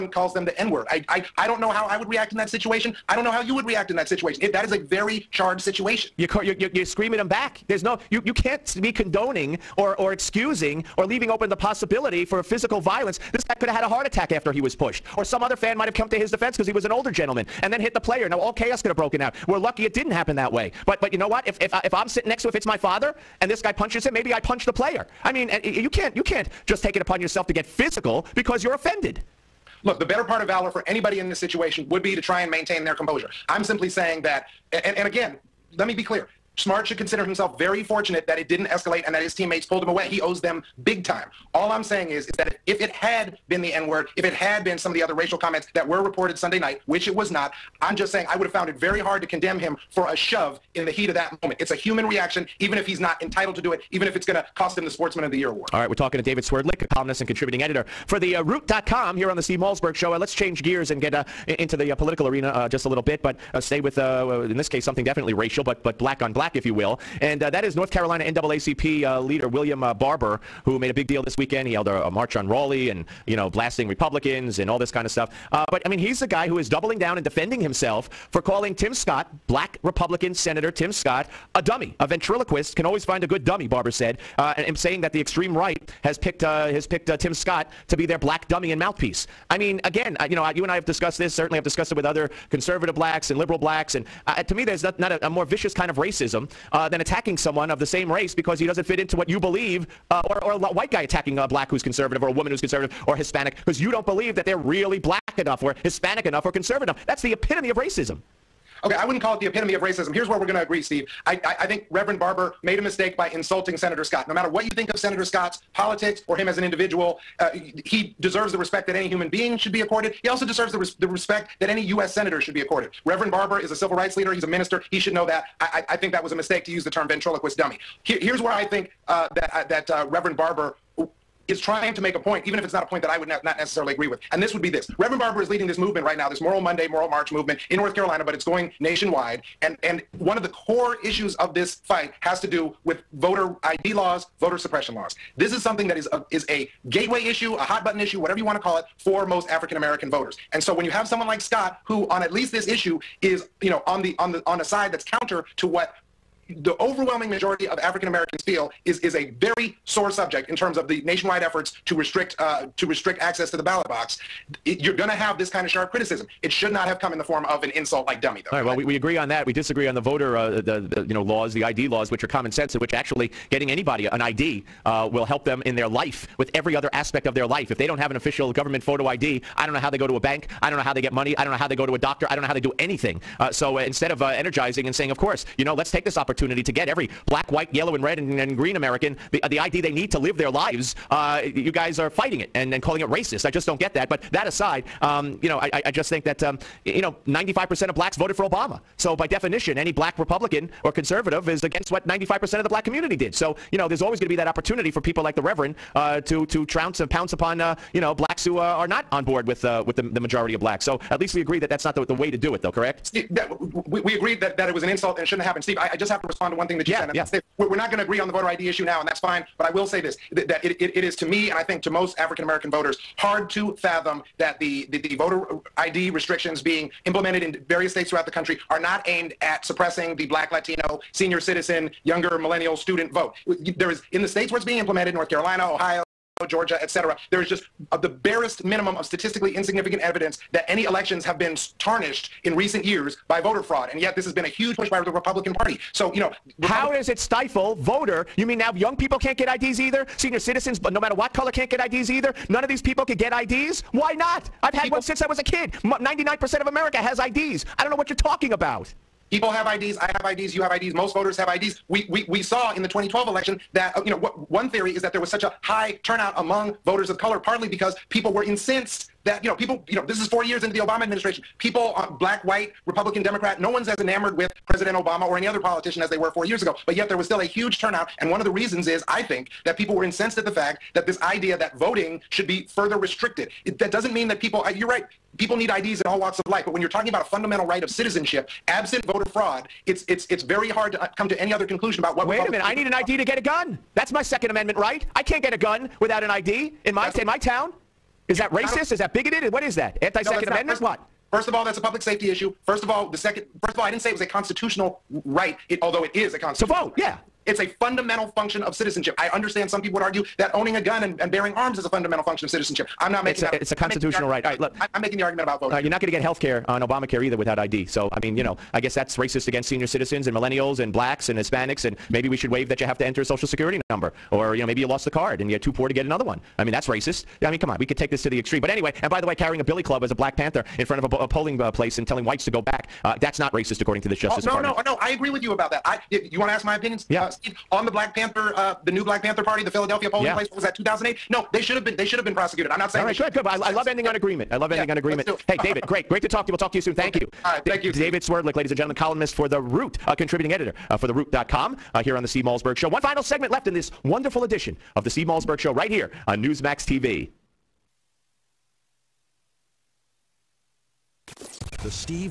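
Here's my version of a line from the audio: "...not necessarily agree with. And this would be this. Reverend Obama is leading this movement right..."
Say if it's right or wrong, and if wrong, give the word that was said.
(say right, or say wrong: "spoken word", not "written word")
wrong: "Barber", not "Obama".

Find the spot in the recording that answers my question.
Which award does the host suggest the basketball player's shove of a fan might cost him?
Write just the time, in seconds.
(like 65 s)
54 s.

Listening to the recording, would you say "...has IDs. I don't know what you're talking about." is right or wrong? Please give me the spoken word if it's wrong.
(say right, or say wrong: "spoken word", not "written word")
right.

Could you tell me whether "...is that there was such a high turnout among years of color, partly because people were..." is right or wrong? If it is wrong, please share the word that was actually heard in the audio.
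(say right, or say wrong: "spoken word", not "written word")
wrong: "voters", not "years".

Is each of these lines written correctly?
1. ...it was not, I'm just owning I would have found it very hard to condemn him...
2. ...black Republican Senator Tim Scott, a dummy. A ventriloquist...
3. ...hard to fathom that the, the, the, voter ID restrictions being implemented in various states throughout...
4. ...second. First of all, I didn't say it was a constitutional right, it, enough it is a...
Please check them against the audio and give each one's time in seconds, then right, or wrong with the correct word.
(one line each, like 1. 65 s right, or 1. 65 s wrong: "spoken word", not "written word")
1. 47 s wrong: "saying", not "owning"
2. 79 s right
3. 223 s right
4. 303 s wrong: "although", not "enough".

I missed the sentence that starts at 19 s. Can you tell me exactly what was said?
We're lucky it didn't happen that way.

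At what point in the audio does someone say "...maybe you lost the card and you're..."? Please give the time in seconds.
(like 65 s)
324 s.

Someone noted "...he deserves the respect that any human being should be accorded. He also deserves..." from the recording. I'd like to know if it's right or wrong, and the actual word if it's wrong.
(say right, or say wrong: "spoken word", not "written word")
right.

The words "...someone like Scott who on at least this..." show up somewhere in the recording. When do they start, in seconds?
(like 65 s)
151 s.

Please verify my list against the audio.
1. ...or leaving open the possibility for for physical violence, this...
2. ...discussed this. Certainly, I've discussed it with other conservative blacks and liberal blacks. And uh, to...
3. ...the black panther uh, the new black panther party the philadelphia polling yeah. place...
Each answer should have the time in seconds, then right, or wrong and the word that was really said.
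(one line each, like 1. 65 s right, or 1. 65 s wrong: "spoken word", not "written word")
1. 10 s right
2. 90 s right
3. 337 s right.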